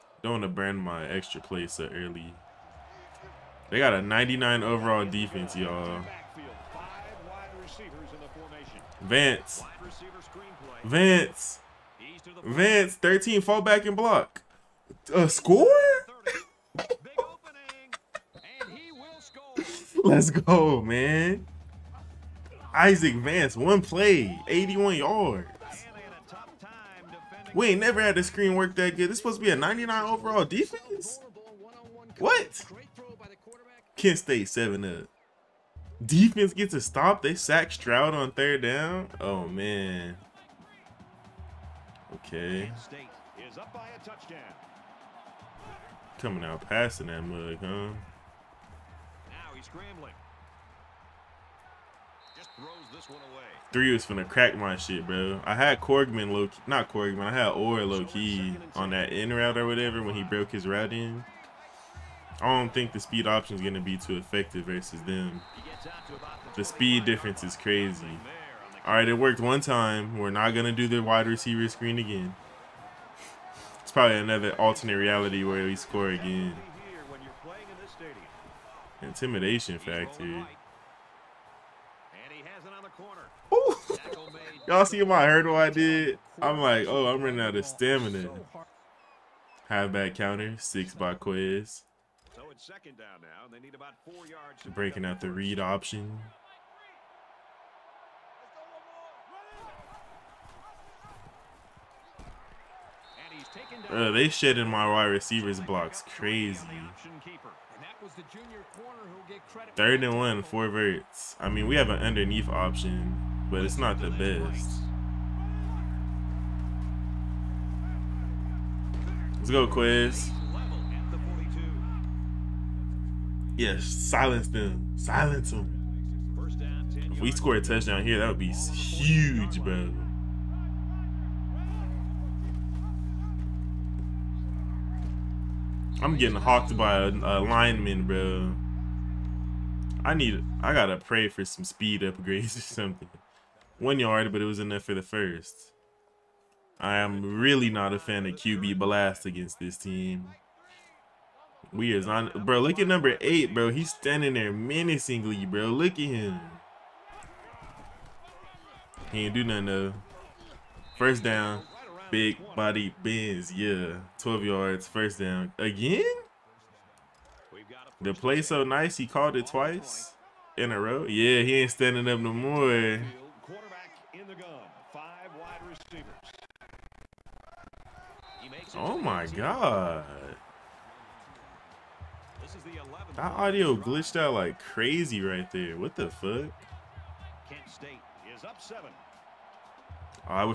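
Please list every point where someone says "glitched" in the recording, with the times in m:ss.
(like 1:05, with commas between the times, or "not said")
3:03.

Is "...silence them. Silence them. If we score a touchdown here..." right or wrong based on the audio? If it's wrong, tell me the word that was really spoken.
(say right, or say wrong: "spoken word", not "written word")
right.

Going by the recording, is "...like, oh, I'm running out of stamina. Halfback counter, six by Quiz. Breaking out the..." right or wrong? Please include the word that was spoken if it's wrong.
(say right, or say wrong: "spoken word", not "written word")
right.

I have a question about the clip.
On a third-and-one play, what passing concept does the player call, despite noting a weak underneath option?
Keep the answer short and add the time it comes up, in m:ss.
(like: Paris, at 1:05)
Four verts, at 1:50.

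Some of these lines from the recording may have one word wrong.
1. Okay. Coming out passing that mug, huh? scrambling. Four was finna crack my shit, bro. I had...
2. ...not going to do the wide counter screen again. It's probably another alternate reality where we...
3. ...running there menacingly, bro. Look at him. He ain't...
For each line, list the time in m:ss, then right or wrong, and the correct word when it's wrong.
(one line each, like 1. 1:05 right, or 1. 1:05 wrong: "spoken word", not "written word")
1. 0:42 wrong: "Three", not "Four"
2. 1:10 wrong: "receiver", not "counter"
3. 2:33 wrong: "standing", not "running".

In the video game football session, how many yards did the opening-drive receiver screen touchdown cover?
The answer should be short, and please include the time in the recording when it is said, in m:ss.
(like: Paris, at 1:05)
81, at 0:24.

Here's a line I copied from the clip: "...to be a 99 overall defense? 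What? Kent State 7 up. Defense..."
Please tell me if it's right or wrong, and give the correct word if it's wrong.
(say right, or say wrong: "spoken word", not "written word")
right.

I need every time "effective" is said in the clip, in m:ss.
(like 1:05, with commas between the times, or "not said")
1:04.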